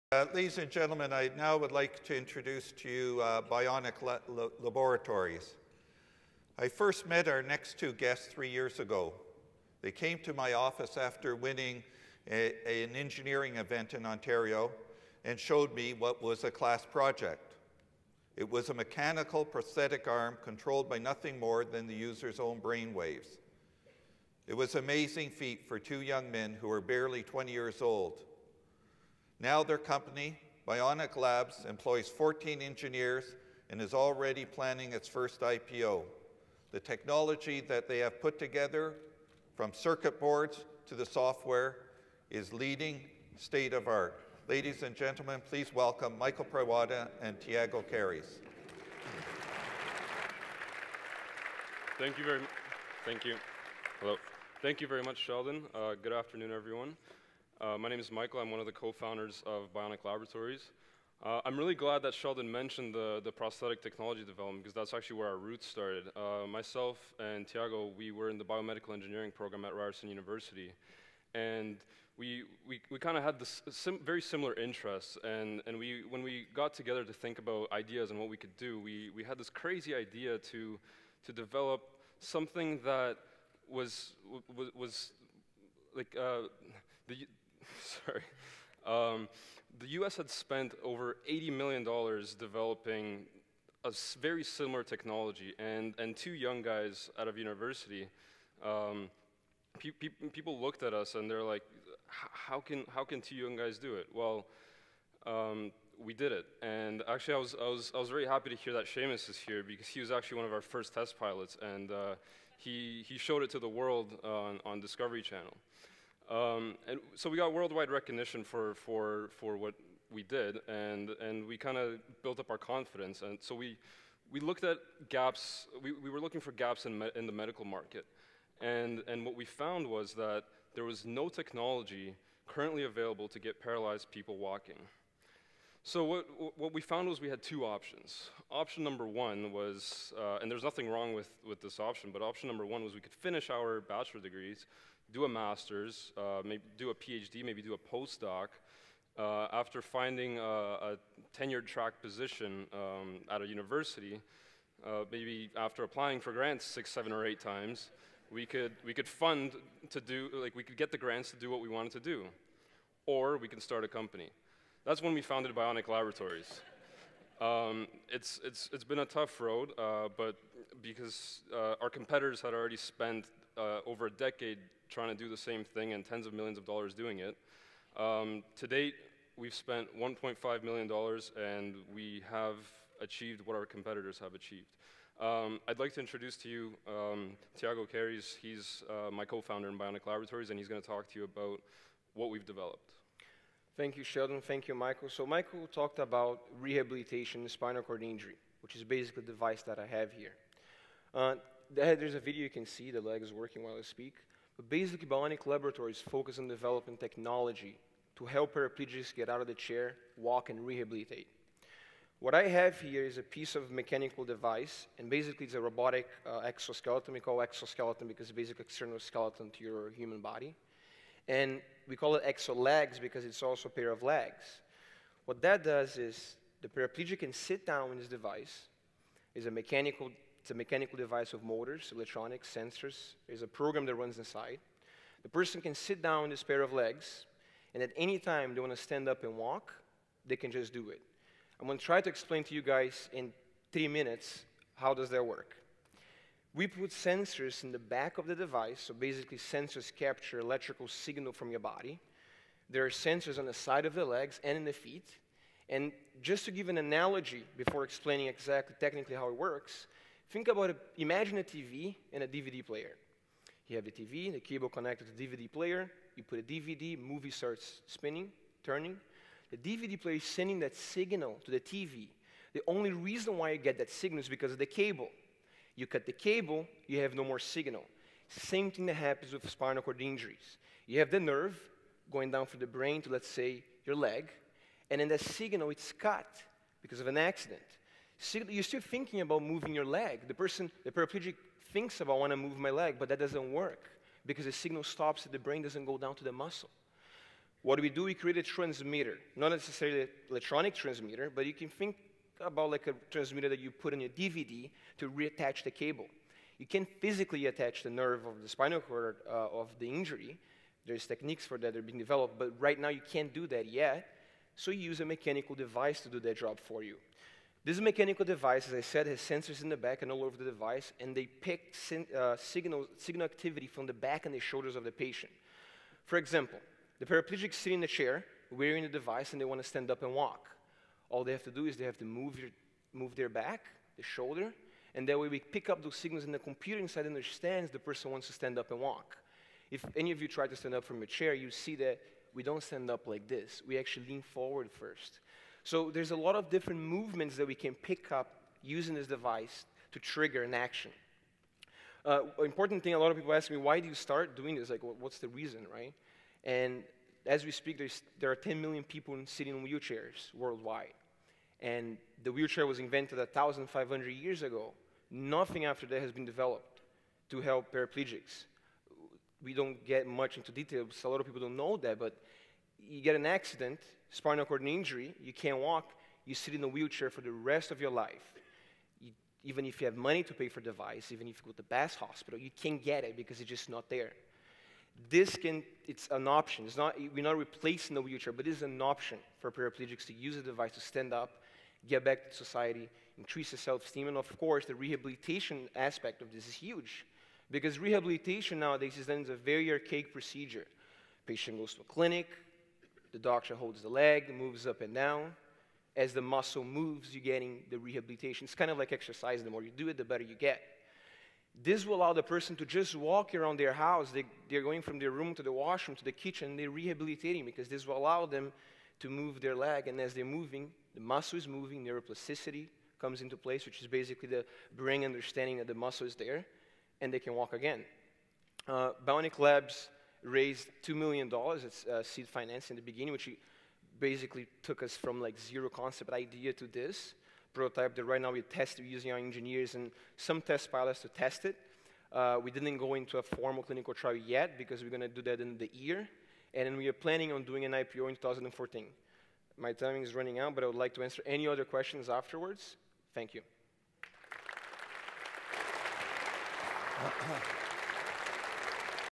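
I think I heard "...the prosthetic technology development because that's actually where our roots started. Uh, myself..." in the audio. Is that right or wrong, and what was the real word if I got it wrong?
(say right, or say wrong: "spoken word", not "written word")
right.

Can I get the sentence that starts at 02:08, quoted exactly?
And, and what we found was that there was no technology currently available to get paralyzed people walking.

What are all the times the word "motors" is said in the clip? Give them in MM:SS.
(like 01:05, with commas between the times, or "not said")
03:51.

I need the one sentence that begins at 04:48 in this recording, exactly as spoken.
you're still thinking about moving your leg.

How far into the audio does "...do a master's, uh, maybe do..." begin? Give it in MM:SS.
02:25.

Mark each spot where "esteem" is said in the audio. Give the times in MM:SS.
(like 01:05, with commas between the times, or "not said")
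06:33.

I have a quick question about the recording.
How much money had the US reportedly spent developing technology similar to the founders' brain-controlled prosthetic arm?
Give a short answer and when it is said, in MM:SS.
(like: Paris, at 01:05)
$80 million, at 01:31.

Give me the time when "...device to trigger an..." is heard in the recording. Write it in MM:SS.
05:49.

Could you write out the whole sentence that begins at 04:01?
I'm going to try to explain to you guys in three minutes how does that work.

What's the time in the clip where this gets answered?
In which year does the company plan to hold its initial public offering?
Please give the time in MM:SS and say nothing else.
07:28.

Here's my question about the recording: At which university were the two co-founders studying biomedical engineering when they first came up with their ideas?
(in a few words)
Ryerson University.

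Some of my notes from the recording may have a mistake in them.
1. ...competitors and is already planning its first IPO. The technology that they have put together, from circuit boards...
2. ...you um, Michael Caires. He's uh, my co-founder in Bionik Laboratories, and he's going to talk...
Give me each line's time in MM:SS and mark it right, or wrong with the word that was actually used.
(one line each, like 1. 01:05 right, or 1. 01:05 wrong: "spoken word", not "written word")
1. 00:32 wrong: "engineers", not "competitors"
2. 03:06 wrong: "Thiago", not "Michael".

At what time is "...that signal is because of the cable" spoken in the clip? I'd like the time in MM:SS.
04:33.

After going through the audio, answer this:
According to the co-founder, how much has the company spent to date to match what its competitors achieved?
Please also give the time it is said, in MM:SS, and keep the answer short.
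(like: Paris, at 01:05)
$1.5 million, at 02:59.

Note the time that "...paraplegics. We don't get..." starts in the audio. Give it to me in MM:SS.
06:07.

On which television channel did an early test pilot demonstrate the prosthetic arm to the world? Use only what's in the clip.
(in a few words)
Discovery Channel.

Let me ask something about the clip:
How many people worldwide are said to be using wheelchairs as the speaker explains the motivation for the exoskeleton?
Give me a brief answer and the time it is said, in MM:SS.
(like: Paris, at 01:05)
10 million, at 05:58.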